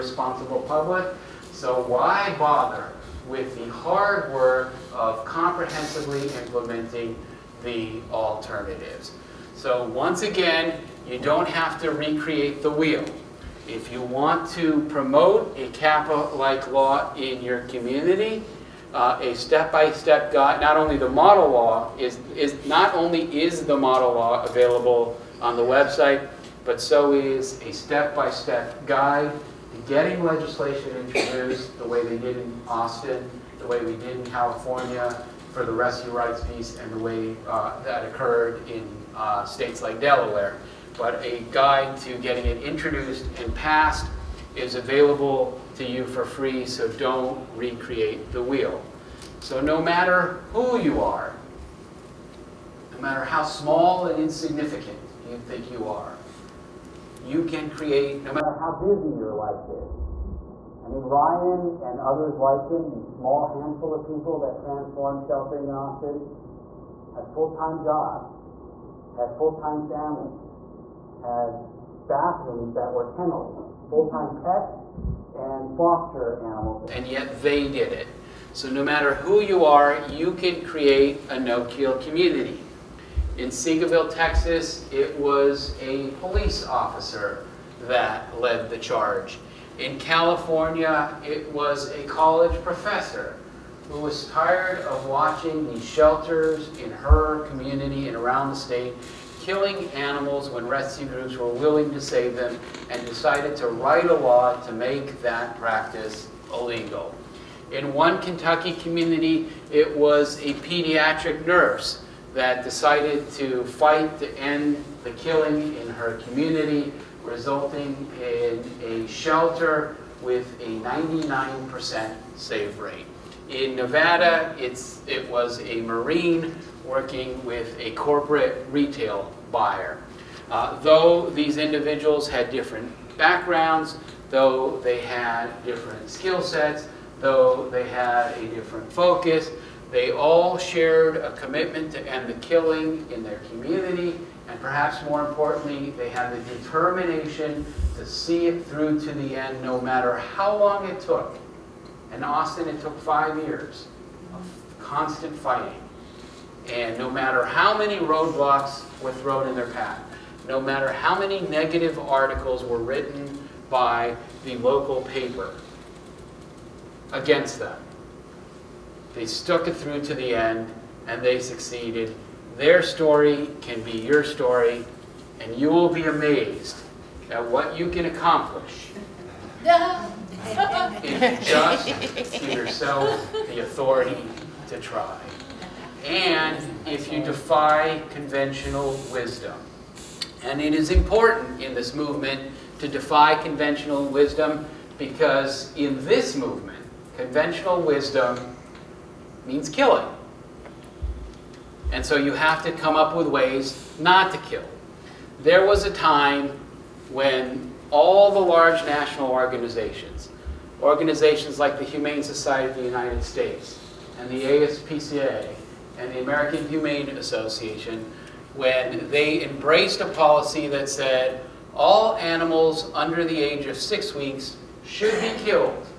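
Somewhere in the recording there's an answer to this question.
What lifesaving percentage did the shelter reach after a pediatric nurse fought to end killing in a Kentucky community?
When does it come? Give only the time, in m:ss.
2:00.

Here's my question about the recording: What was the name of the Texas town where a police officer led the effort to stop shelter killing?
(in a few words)
Seagoville.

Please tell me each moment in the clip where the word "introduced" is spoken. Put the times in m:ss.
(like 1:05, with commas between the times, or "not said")
0:31, 0:42.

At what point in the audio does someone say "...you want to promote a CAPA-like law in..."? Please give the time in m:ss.
0:13.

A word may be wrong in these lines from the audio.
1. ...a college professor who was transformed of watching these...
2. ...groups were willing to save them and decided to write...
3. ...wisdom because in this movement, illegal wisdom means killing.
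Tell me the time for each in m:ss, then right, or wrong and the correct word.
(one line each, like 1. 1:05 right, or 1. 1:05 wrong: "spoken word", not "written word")
1. 1:31 wrong: "tired", not "transformed"
2. 1:41 right
3. 3:14 wrong: "conventional", not "illegal".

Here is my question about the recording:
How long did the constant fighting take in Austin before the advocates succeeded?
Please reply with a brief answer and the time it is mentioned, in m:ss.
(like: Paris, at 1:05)
5 years, at 2:33.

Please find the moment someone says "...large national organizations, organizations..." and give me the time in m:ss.
3:28.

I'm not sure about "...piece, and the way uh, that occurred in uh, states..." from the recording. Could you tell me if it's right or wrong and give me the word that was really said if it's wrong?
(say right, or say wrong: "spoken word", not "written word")
right.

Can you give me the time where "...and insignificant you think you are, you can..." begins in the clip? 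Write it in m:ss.
0:54.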